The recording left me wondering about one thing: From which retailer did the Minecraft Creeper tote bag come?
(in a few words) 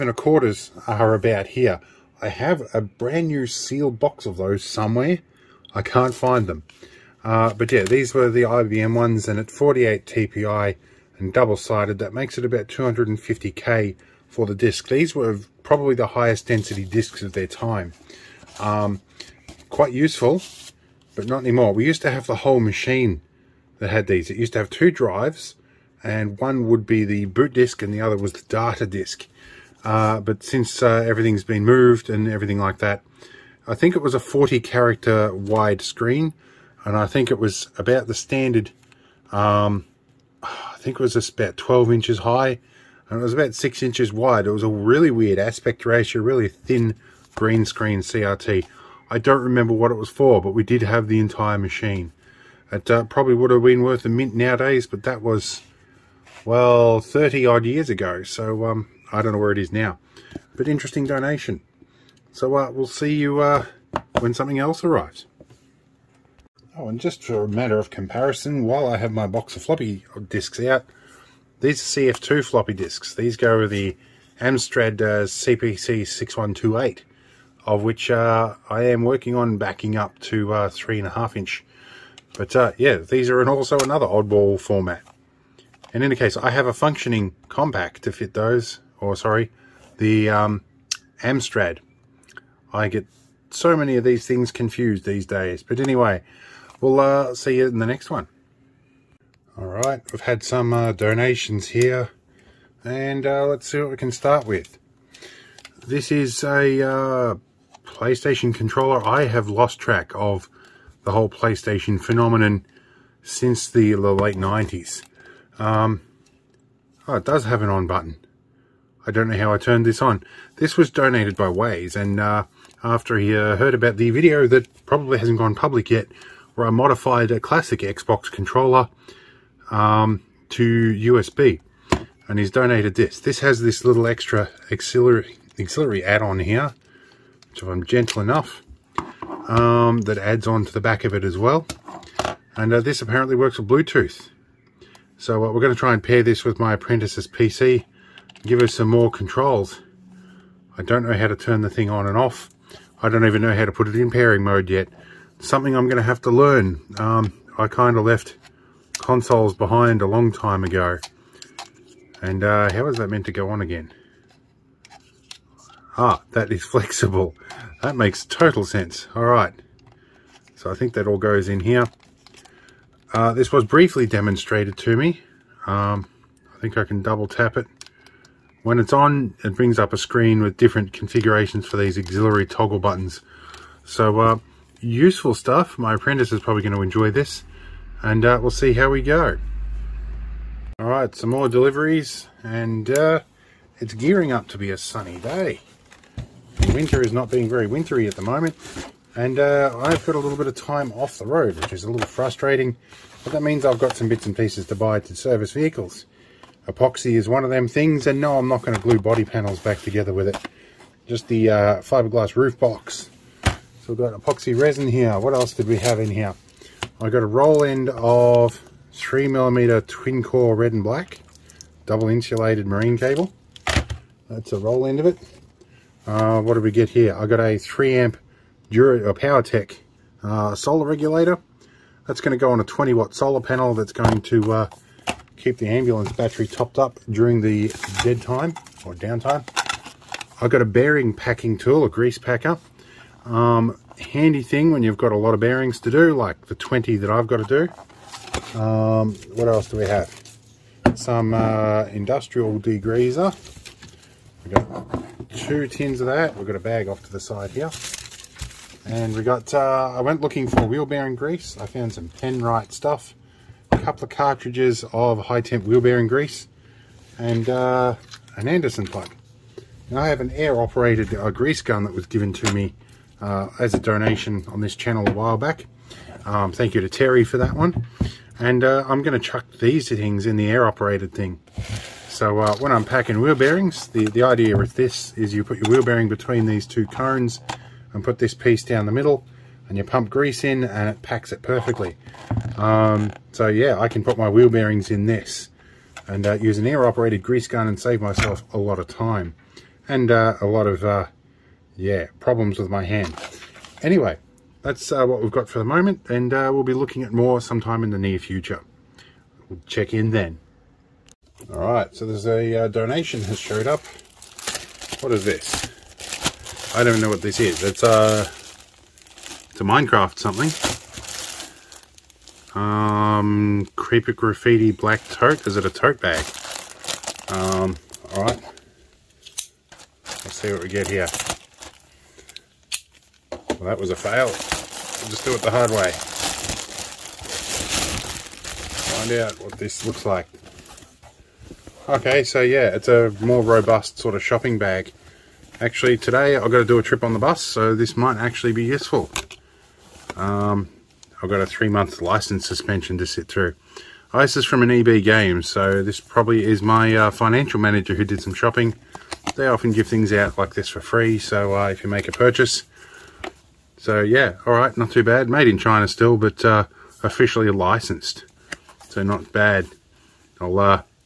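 EB Games.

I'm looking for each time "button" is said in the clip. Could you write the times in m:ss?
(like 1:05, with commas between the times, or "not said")
1:57, 3:02.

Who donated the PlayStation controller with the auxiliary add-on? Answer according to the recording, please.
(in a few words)
Waze.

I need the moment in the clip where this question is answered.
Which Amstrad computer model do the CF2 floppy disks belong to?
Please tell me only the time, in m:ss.
1:15.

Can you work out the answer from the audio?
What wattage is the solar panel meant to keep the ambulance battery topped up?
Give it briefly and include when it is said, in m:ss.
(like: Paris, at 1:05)
20 watt, at 3:52.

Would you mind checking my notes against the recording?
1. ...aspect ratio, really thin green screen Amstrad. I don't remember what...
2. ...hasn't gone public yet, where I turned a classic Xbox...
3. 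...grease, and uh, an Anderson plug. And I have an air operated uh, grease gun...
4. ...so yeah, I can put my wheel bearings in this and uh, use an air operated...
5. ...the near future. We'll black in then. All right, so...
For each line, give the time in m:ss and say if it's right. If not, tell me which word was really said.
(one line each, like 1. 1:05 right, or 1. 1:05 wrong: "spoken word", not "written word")
1. 0:45 wrong: "CRT", not "Amstrad"
2. 2:05 wrong: "modified", not "turned"
3. 4:26 right
4. 4:53 right
5. 5:07 wrong: "check", not "black".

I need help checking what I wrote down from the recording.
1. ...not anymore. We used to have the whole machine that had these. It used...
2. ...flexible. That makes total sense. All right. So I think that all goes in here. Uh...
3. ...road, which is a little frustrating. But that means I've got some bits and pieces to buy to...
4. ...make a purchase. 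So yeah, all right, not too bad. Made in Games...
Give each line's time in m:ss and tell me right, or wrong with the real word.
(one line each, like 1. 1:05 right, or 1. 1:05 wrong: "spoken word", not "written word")
1. 0:21 right
2. 2:46 right
3. 3:21 right
4. 6:01 wrong: "China", not "Games".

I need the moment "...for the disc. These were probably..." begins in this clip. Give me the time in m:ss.
0:14.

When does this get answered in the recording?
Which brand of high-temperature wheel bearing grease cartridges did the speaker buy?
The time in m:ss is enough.
4:22.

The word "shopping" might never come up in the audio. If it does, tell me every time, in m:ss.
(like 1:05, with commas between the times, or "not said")
5:44, 5:58.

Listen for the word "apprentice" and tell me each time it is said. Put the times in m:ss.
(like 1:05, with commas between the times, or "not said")
2:26, 3:05.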